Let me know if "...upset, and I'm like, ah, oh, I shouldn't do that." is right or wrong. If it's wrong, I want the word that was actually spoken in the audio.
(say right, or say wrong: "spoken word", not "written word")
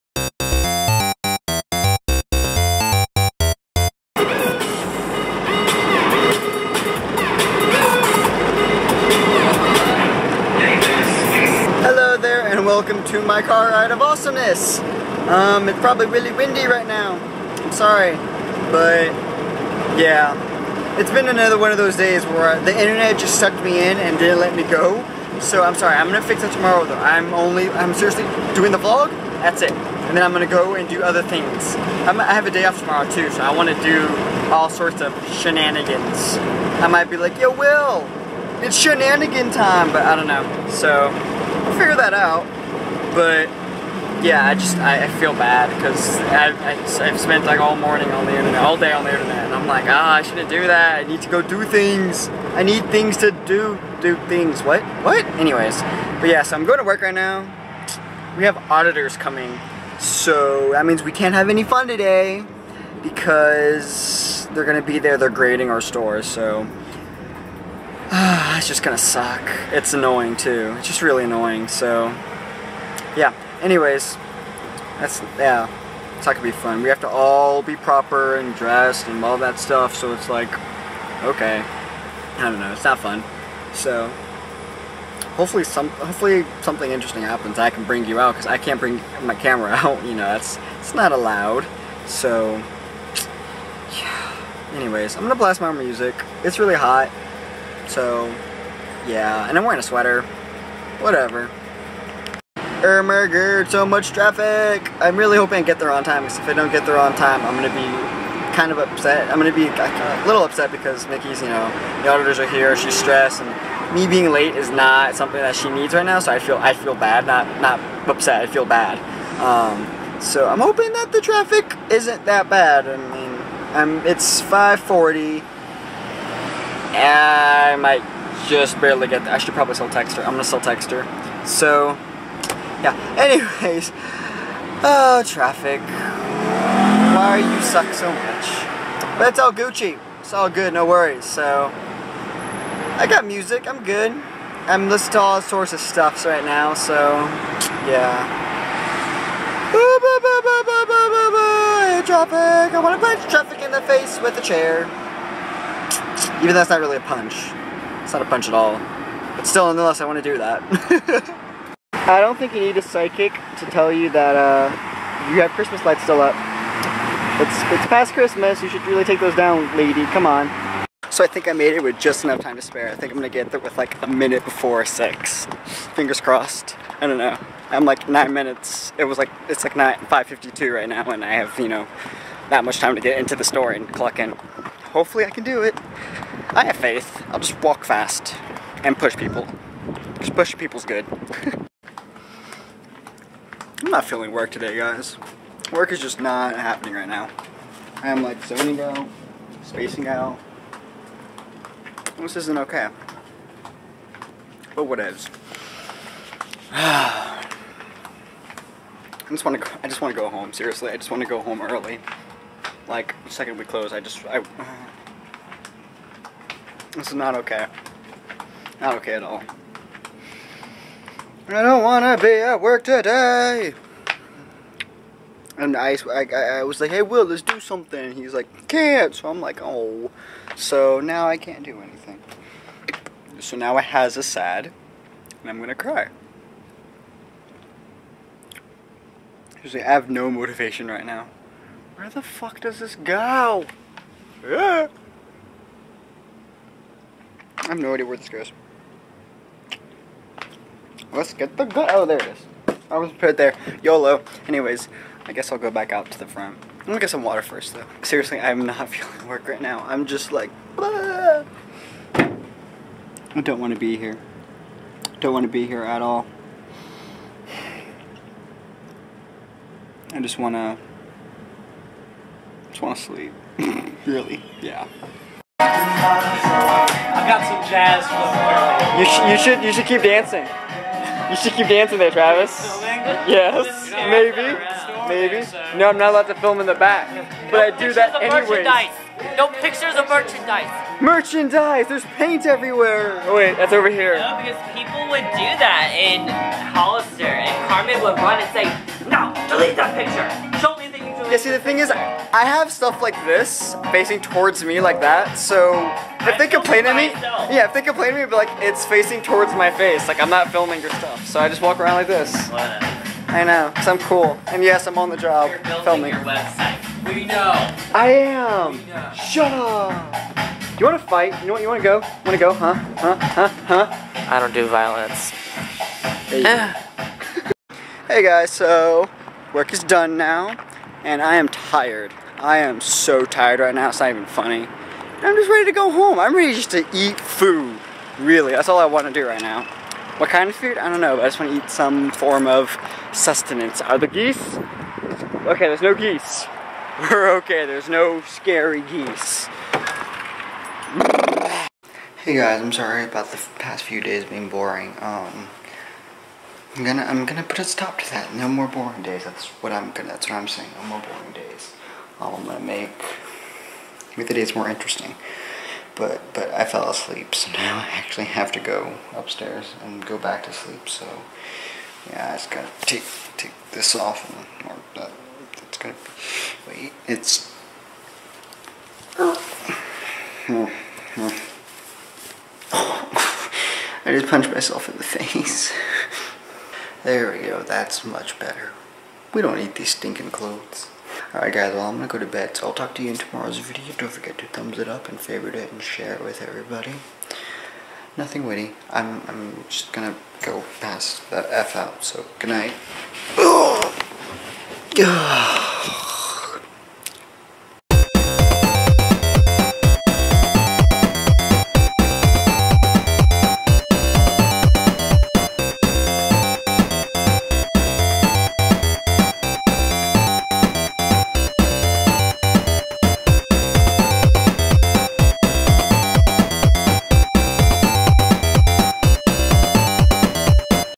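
wrong: "internet", not "upset".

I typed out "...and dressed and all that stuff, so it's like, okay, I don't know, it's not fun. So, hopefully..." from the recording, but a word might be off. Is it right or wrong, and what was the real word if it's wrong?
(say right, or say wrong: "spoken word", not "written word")
right.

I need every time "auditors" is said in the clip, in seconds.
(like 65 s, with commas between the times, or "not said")
58 s, 112 s.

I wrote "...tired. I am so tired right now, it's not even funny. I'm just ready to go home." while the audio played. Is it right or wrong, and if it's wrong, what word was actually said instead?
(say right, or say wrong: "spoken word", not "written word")
right.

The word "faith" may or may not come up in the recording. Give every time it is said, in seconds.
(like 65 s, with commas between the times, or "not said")
186 s.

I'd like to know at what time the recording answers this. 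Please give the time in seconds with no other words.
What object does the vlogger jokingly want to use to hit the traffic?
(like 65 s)
154 s.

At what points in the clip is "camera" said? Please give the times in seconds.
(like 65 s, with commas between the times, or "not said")
89 s.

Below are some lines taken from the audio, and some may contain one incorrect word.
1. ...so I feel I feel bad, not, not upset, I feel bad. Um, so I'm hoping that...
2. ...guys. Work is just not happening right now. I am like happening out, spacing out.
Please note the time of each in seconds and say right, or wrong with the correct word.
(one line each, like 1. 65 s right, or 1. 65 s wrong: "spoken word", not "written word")
1. 116 s right
2. 194 s wrong: "zoning", not "happening".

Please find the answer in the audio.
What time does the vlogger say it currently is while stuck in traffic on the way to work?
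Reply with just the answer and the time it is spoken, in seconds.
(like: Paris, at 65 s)
5:40, at 124 s.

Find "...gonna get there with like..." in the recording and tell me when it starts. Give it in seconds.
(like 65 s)
173 s.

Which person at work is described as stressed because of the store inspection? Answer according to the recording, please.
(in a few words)
Mickey.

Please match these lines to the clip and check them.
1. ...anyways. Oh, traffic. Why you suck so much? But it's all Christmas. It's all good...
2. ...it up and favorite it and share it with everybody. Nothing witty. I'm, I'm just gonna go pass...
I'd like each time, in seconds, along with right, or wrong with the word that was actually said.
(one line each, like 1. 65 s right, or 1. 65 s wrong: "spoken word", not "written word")
1. 133 s wrong: "Gucci", not "Christmas"
2. 394 s right.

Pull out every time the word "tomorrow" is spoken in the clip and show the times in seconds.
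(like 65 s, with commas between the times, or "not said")
26 s, 32 s, 393 s.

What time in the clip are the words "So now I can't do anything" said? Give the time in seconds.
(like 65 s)
230 s.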